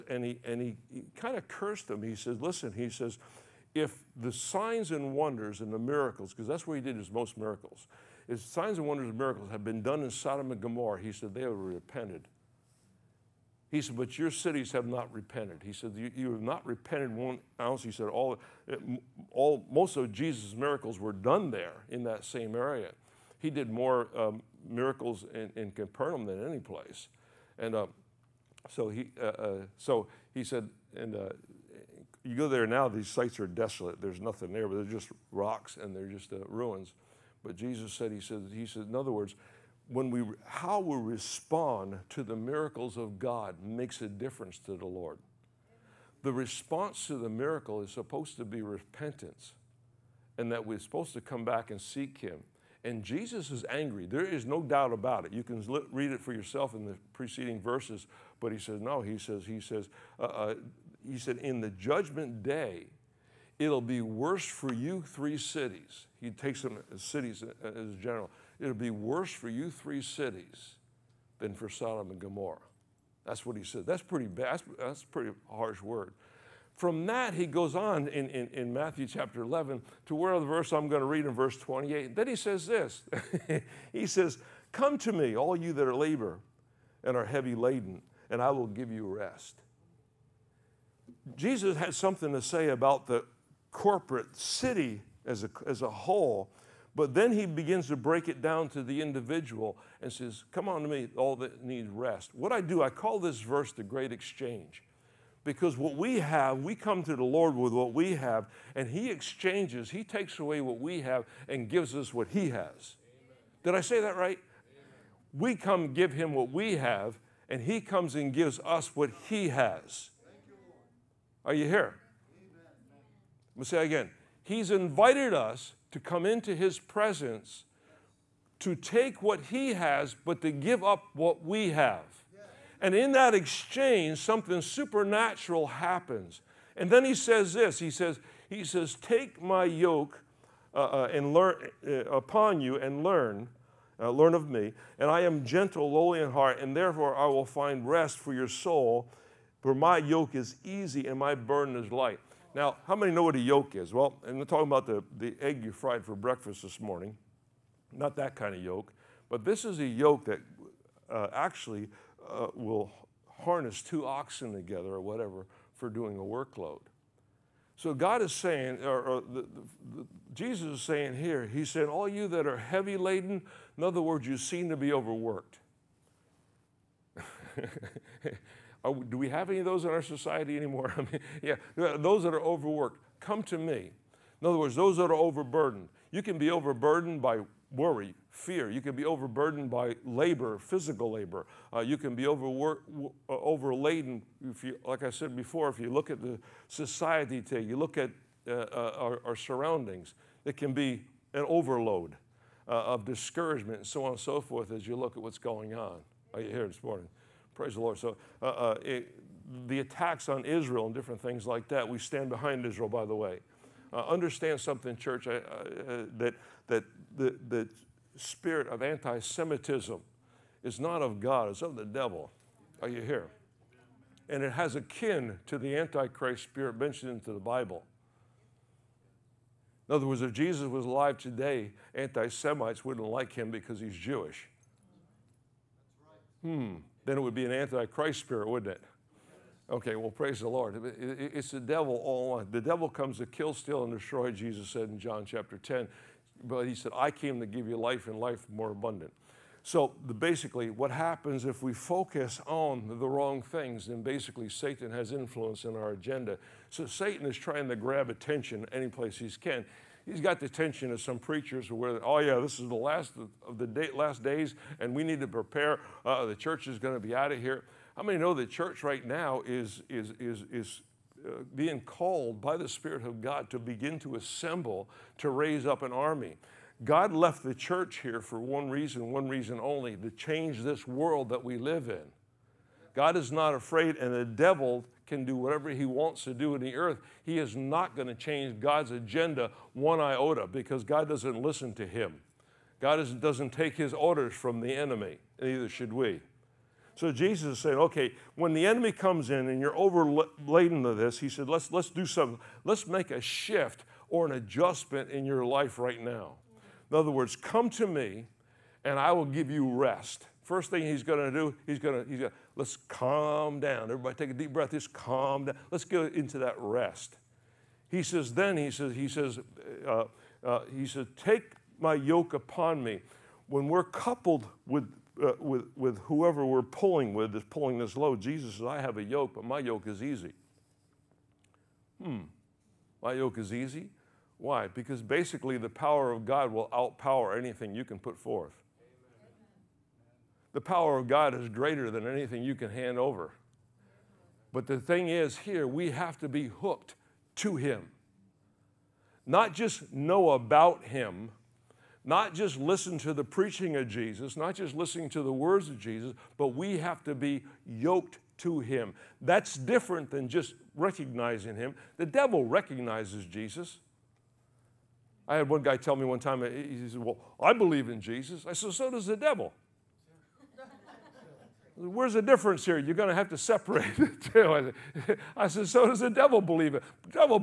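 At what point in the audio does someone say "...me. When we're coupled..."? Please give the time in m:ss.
5:22.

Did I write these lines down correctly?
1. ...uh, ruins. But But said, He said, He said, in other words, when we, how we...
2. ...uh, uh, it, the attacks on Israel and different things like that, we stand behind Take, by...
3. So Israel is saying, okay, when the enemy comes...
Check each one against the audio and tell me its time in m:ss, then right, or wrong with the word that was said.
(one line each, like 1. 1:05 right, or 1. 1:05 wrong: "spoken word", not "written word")
1. 0:36 wrong: "Jesus", not "But"
2. 3:28 wrong: "Israel", not "Take"
3. 4:56 wrong: "Jesus", not "Israel".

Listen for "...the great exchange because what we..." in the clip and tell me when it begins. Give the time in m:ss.
1:43.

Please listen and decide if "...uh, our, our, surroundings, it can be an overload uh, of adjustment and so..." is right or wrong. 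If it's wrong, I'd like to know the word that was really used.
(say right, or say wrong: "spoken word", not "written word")
wrong: "discouragement", not "adjustment".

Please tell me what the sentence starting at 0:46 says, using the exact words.
The response to the miracle is supposed to be repentance and that we're supposed to come back and seek Him.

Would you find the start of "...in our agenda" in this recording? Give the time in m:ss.
4:15.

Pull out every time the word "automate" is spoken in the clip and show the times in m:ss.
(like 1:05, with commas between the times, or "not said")
not said.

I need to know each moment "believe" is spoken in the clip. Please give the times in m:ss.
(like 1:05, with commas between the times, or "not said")
6:07, 6:16.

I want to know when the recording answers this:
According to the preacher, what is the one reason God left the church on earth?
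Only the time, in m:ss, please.
4:39.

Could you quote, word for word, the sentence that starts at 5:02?
Let's make a shift or an adjustment in your life right now.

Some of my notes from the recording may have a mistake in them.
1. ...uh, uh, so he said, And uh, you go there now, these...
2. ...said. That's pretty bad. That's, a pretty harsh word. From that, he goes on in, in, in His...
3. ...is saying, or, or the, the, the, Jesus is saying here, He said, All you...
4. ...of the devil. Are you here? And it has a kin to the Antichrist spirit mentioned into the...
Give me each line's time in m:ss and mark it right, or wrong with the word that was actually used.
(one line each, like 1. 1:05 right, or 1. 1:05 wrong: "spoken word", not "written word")
1. 0:29 right
2. 1:13 wrong: "Matthew", not "His"
3. 2:48 right
4. 3:41 right.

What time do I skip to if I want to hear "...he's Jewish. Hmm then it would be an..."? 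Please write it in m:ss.
3:53.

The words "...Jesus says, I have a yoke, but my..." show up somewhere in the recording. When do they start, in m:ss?
5:28.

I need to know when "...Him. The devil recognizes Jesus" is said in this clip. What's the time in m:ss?
6:01.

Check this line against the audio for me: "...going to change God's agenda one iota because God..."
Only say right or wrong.
right.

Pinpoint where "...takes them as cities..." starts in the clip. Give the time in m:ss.
1:06.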